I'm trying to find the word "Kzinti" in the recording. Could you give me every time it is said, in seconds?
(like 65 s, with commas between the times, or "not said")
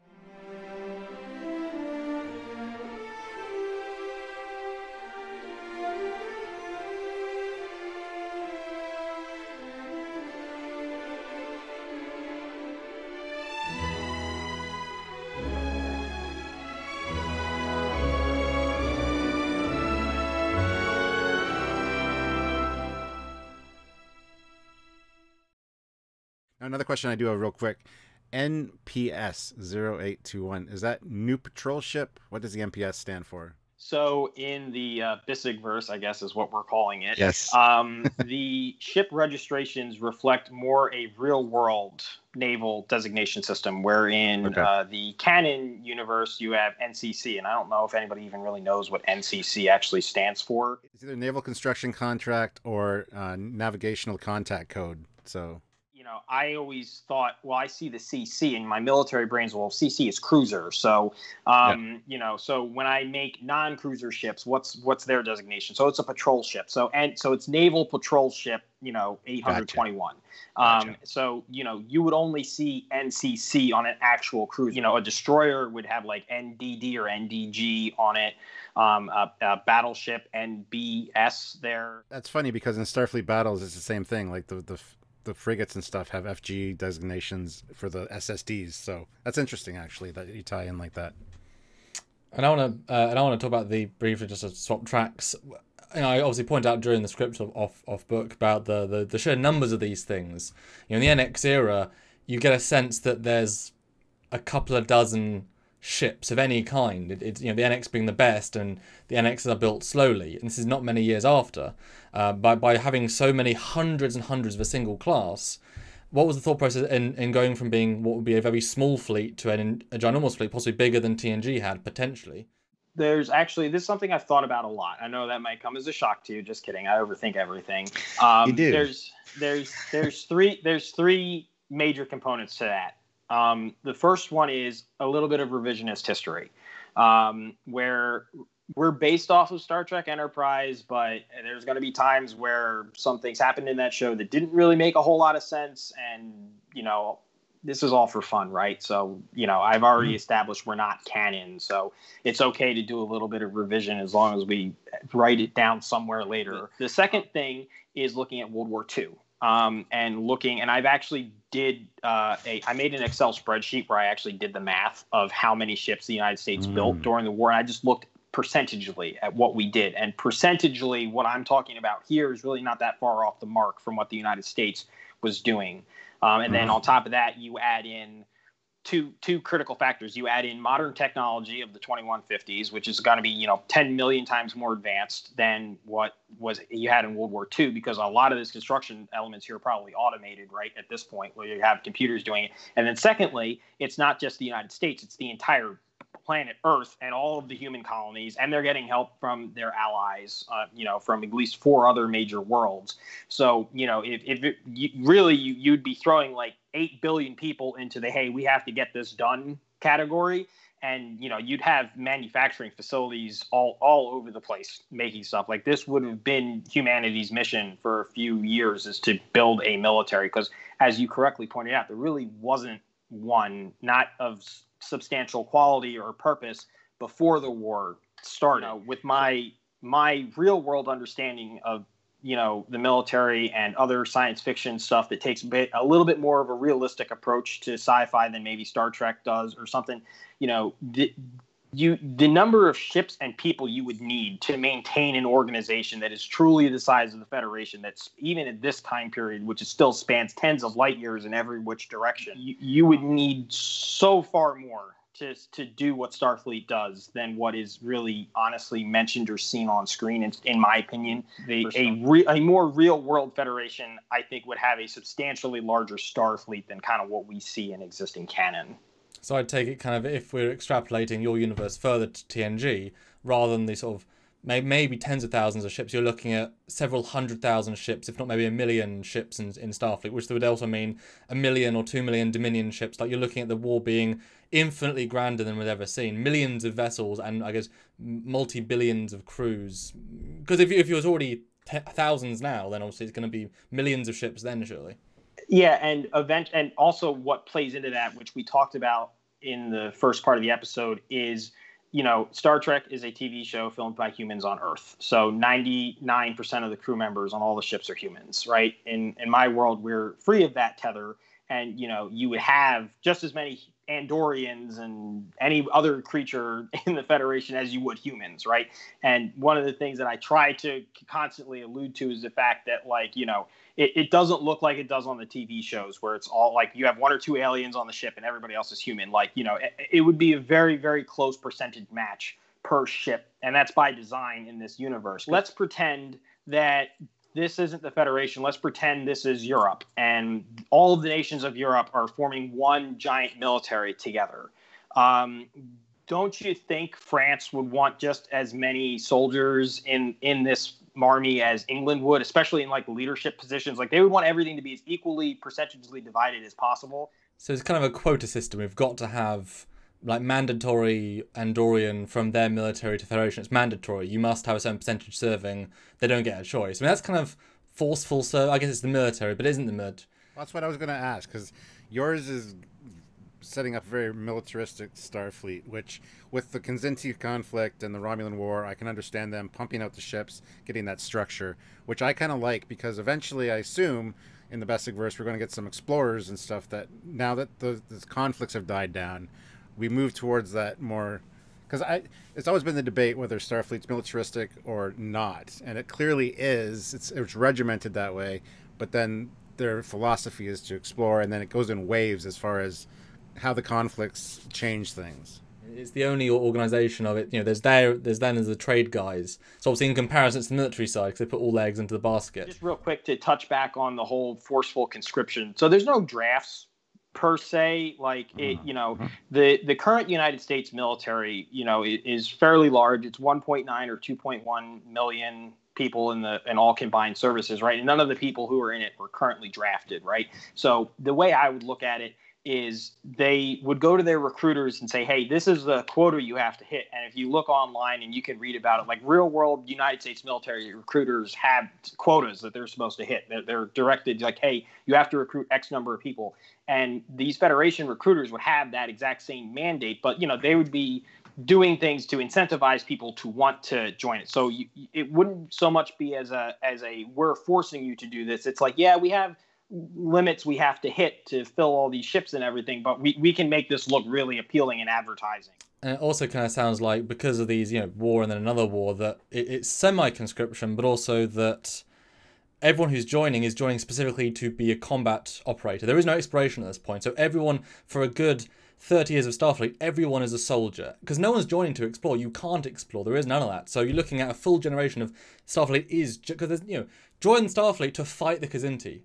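376 s, 488 s.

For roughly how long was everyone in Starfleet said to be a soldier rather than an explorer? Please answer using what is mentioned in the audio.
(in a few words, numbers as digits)
30 years.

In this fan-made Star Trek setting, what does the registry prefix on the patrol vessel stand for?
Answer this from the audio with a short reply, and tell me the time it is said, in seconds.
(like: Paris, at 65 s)
Naval patrol ship, at 67 s.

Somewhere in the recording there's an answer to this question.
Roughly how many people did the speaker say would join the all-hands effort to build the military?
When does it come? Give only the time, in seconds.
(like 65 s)
206 s.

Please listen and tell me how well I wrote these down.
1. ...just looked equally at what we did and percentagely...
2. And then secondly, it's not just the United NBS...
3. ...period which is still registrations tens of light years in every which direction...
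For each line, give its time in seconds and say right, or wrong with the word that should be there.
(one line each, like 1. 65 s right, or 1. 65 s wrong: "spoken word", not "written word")
1. 167 s wrong: "percentagely", not "equally"
2. 192 s wrong: "States", not "NBS"
3. 249 s wrong: "spans", not "registrations".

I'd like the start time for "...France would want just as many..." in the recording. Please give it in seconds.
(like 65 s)
346 s.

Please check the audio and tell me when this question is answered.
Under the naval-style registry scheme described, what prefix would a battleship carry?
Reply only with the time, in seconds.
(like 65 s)
80 s.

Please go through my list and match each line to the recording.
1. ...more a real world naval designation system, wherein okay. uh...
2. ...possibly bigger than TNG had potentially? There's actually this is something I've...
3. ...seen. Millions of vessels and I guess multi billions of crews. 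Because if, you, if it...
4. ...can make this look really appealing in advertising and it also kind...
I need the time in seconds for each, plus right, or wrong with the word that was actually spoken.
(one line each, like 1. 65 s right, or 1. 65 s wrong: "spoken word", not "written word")
1. 40 s right
2. 120 s right
3. 285 s right
4. 463 s right.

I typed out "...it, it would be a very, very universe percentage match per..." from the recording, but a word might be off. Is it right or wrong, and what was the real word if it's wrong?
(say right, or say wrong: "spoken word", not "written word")
wrong: "close", not "universe".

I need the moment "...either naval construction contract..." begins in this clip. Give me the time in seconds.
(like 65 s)
51 s.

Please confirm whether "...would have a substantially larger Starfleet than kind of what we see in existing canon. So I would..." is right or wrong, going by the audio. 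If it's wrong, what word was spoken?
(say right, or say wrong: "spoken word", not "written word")
right.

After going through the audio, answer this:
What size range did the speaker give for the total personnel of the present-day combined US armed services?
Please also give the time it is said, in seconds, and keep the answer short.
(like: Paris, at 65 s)
1.9 or 2.1 million, at 423 s.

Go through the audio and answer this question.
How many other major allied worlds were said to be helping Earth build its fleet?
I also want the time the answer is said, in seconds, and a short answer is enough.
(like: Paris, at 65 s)
4, at 201 s.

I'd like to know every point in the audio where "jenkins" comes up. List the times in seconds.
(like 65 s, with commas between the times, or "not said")
not said.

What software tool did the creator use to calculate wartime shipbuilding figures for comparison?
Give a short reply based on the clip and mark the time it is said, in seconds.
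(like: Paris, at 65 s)
Excel spreadsheet, at 163 s.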